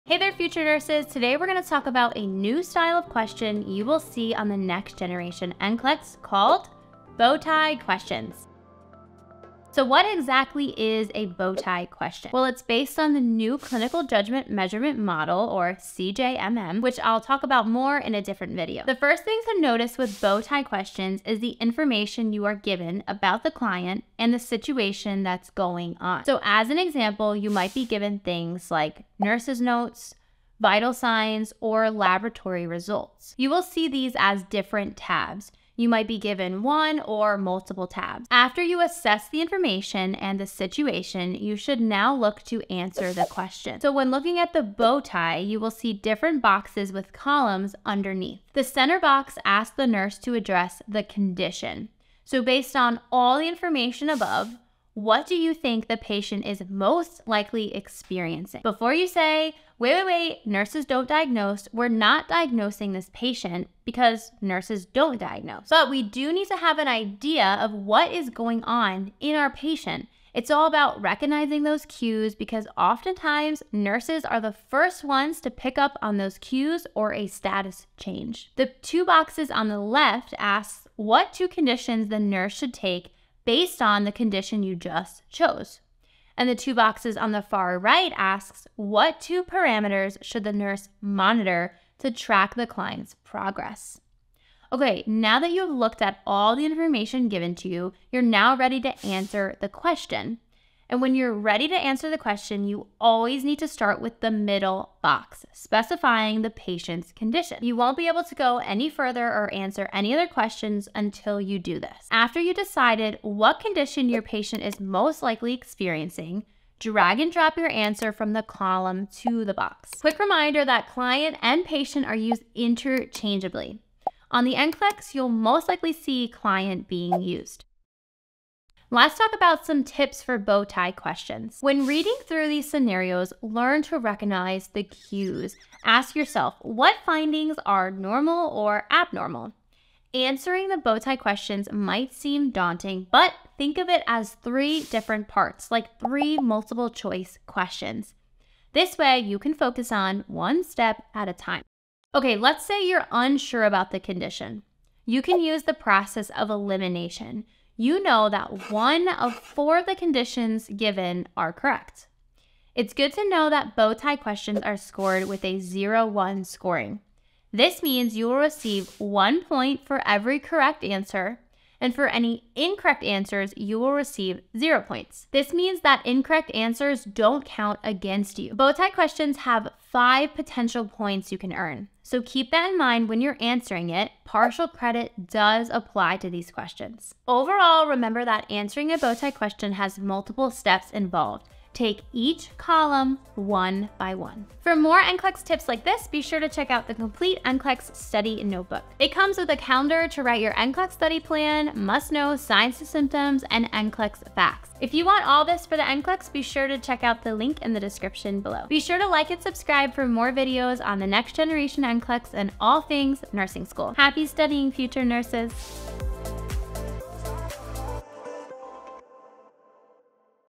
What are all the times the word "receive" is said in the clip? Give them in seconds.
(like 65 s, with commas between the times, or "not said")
168 s, 173 s.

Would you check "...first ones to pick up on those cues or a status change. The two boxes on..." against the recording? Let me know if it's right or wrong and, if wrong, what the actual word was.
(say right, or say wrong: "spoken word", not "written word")
right.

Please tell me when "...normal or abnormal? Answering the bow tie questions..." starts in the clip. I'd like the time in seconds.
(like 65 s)
137 s.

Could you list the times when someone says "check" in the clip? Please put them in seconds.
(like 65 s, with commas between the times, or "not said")
196 s, 206 s.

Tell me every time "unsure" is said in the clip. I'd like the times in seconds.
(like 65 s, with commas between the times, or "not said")
153 s.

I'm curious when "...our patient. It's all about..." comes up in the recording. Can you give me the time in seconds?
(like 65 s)
69 s.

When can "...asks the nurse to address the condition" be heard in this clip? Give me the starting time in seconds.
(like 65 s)
49 s.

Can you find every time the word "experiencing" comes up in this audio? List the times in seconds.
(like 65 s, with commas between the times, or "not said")
57 s, 115 s.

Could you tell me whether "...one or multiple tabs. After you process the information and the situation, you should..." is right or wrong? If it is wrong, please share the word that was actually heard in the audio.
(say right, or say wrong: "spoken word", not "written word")
wrong: "assess", not "process".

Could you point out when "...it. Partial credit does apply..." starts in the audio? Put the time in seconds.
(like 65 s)
183 s.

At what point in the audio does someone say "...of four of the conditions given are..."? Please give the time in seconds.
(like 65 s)
159 s.